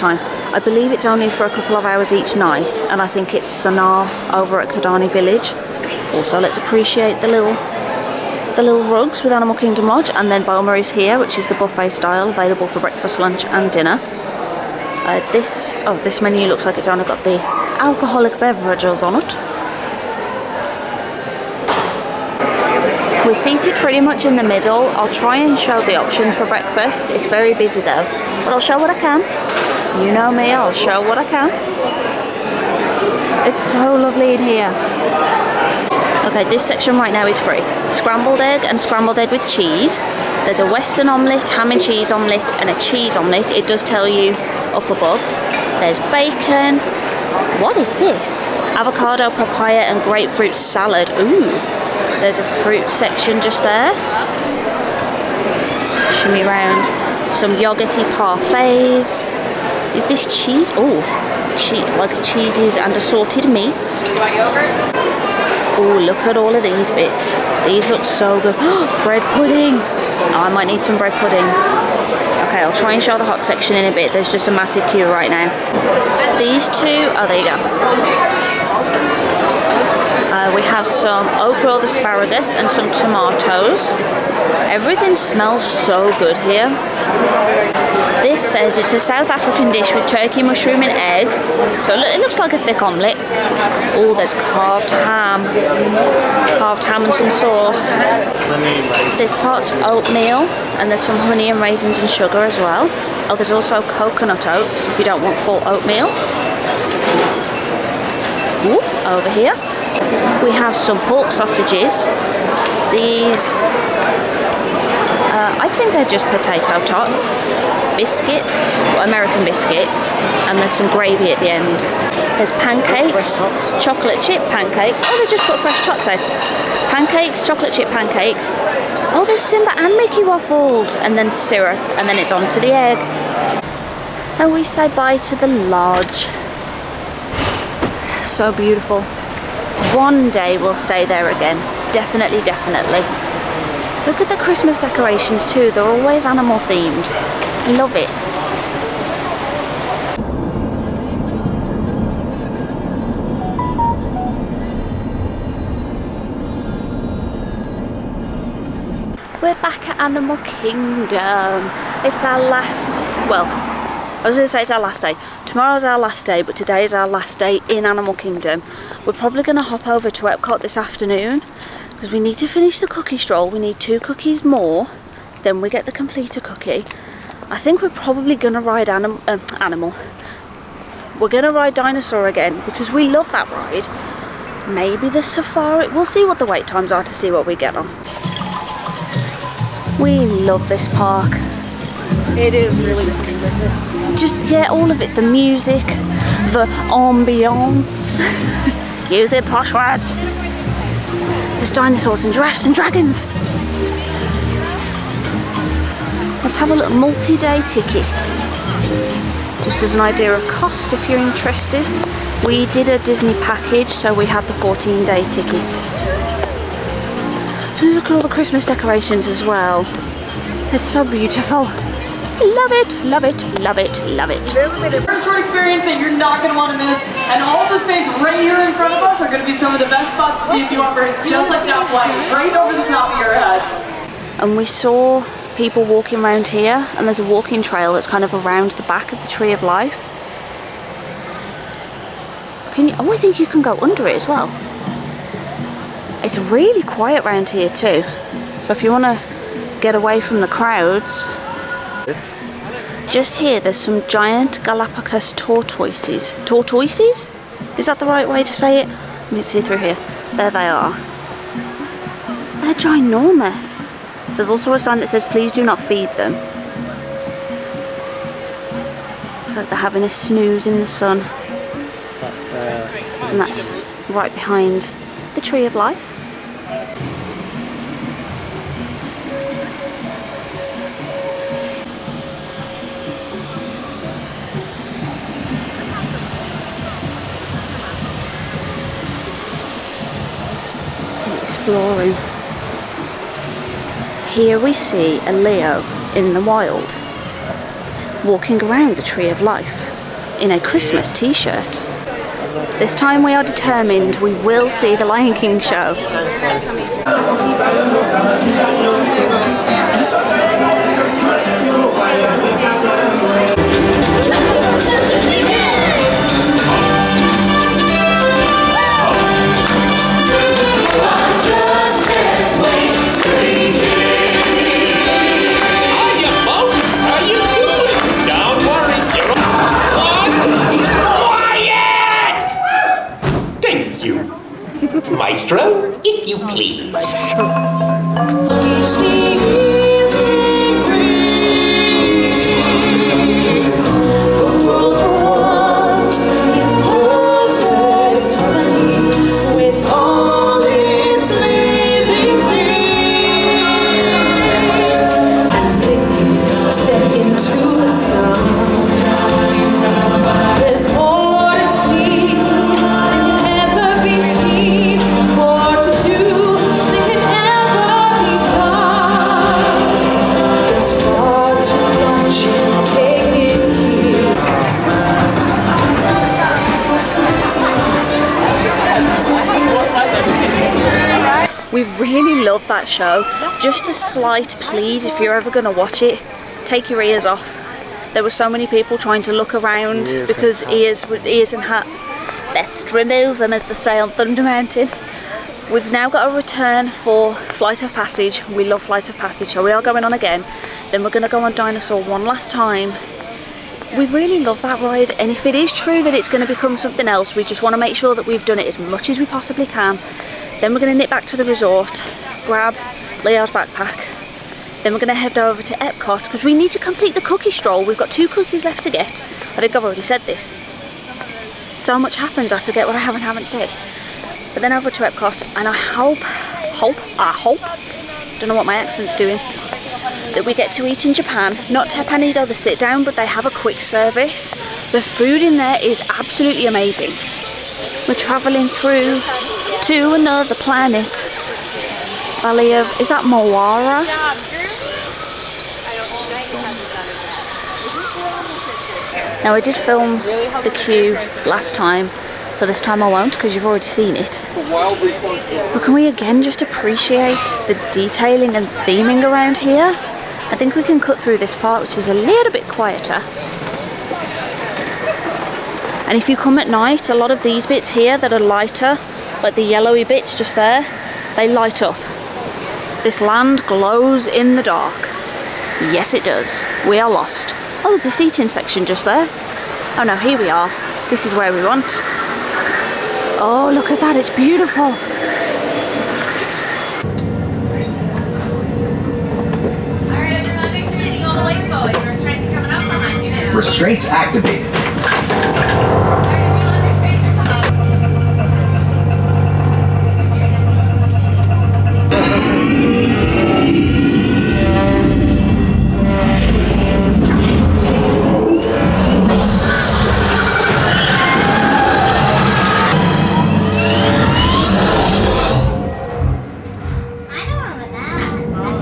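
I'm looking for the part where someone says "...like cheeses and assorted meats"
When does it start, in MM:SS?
01:01.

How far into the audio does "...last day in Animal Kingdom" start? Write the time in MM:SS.
02:47.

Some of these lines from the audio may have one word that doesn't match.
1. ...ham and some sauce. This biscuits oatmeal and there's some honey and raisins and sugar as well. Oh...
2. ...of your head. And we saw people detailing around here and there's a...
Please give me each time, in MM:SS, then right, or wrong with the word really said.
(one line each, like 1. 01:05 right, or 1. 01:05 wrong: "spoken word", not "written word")
1. 01:36 wrong: "parts", not "biscuits"
2. 03:53 wrong: "walking", not "detailing".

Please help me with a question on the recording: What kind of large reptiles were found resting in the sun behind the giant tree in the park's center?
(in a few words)
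Galapagos tortoises.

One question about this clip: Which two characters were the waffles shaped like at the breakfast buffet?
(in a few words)
Simba and Mickey.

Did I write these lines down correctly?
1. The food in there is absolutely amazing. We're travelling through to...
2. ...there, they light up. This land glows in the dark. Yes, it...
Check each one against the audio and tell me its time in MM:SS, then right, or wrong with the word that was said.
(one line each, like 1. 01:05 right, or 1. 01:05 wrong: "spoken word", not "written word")
1. 07:14 right
2. 07:50 right.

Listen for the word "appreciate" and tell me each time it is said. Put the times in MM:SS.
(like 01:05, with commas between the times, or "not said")
00:06, 07:36.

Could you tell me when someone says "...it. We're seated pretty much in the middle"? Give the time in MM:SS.
00:19.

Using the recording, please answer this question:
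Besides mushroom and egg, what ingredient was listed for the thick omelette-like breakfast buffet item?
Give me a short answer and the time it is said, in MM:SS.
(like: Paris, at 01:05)
Turkey, at 01:30.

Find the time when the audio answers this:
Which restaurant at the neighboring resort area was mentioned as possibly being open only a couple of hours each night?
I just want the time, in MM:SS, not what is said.
00:03.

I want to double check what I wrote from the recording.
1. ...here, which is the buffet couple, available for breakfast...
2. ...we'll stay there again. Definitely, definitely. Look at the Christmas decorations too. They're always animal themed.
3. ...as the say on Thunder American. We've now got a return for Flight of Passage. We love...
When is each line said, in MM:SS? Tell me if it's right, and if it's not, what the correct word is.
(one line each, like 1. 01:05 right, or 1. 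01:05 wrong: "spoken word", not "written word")
1. 00:10 wrong: "style", not "couple"
2. 02:20 right
3. 06:33 wrong: "Mountain", not "American".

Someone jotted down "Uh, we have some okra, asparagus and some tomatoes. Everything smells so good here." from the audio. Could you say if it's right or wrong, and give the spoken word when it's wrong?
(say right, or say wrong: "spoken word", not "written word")
right.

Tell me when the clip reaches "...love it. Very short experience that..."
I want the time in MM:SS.
03:44.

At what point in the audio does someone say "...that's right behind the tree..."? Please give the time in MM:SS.
04:33.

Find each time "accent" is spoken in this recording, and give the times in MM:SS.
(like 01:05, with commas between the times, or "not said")
07:08.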